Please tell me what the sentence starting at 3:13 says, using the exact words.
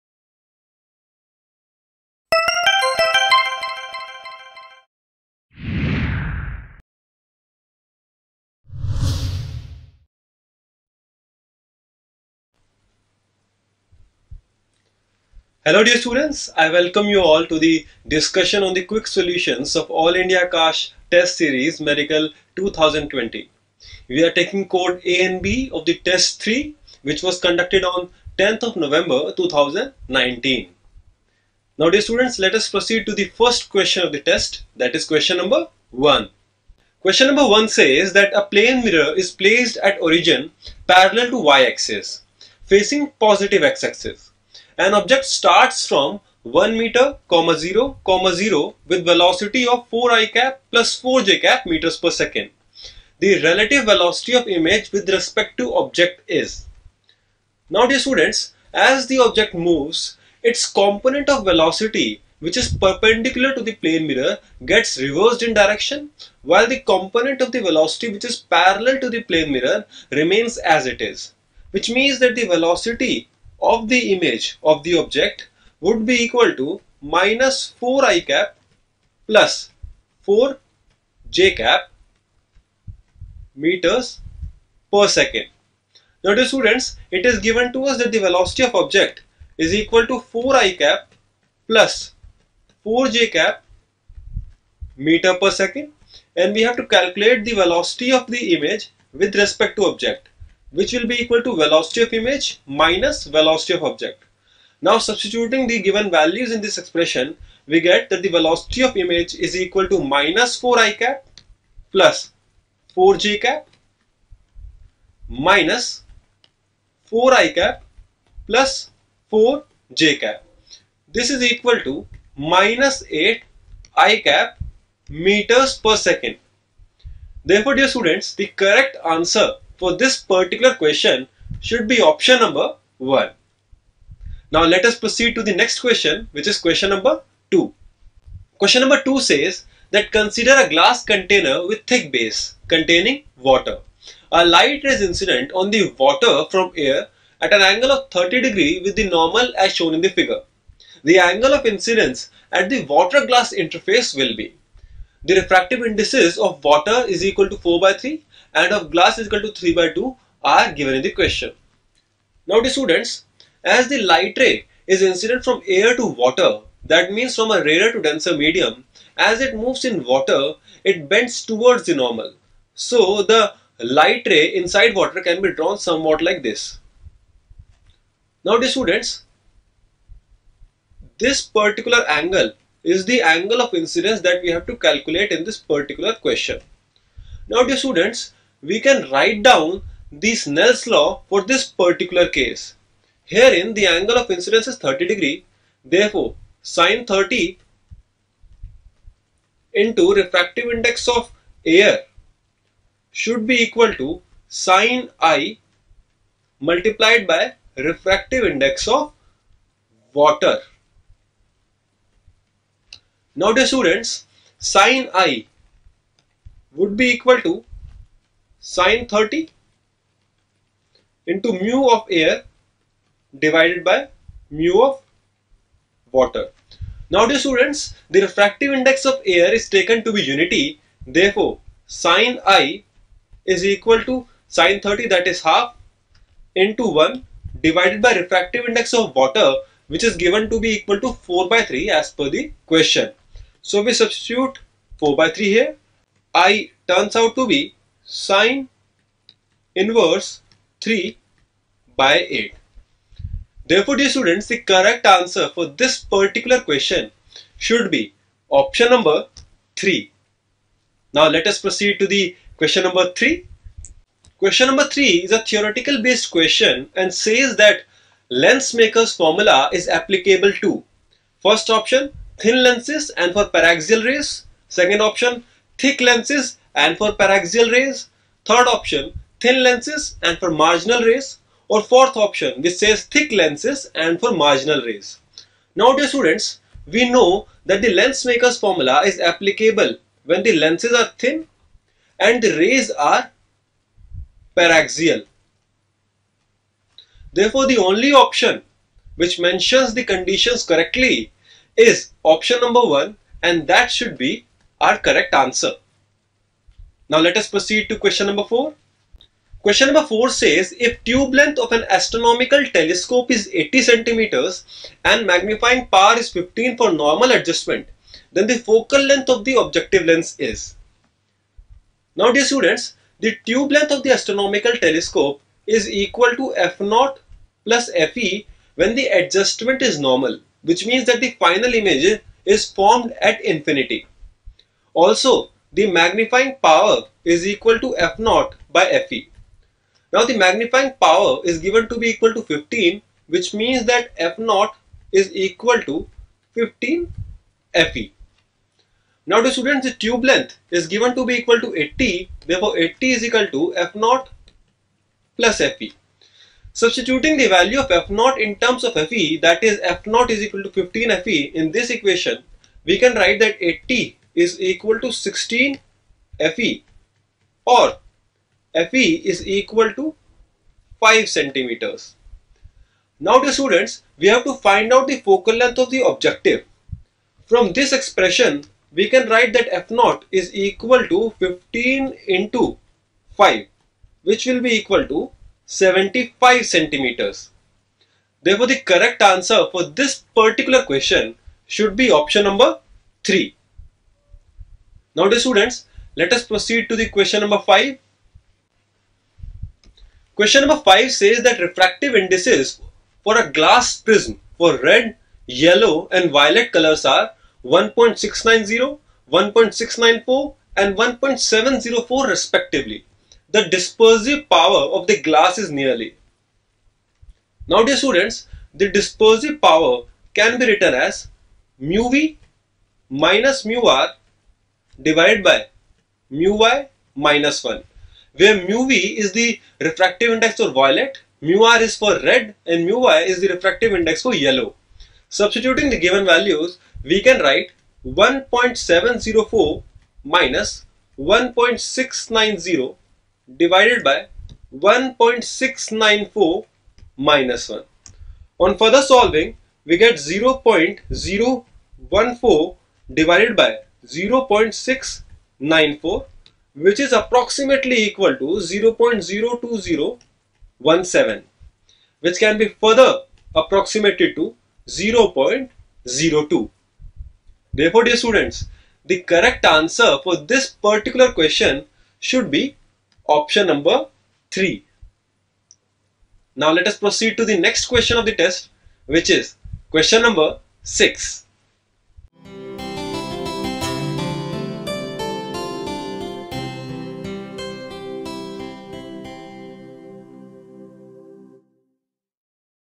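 Herein the angle of incidence is 30 degree.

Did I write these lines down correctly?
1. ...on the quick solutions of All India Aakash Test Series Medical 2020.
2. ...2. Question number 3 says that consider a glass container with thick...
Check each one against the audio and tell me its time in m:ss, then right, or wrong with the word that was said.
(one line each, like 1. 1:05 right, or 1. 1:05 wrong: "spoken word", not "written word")
1. 0:18 right
2. 2:17 wrong: "2", not "3".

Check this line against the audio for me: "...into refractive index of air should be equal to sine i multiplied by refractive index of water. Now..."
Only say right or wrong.
right.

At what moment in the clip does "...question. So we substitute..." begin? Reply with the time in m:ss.
4:02.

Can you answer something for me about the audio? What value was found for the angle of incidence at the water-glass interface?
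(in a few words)
sin inverse 3/8.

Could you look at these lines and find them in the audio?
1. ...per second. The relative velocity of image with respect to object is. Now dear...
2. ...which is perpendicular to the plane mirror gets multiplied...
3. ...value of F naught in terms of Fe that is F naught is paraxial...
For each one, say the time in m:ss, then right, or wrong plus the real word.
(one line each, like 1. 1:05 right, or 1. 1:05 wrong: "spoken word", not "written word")
1. 0:51 right
2. 1:02 wrong: "reversed", not "multiplied"
3. 5:57 wrong: "equal", not "paraxial".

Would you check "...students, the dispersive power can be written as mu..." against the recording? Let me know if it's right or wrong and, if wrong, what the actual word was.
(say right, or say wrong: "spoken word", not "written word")
right.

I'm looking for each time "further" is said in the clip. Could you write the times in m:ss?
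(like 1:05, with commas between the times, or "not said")
7:28, 7:42.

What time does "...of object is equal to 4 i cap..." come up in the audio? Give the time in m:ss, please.
1:28.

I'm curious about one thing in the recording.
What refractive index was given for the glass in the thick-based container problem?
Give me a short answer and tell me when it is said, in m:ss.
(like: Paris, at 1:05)
3/2, at 2:39.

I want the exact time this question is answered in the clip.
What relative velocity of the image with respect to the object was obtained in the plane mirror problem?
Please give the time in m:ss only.
2:02.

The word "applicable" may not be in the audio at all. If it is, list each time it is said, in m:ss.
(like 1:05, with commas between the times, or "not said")
4:29, 4:49.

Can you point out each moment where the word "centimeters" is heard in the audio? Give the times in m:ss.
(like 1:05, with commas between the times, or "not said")
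5:13, 6:11, 6:26.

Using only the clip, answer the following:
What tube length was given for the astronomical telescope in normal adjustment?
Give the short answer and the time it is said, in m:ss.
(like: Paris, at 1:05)
80 cm, at 5:13.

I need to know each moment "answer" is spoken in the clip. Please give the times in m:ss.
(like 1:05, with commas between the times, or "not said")
2:09, 4:15, 5:05, 6:29, 7:49.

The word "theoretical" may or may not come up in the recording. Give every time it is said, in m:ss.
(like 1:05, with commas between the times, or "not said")
4:25.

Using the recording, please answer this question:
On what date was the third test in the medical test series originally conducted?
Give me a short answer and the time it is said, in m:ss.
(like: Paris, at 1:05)
10th of November 2019, at 0:28.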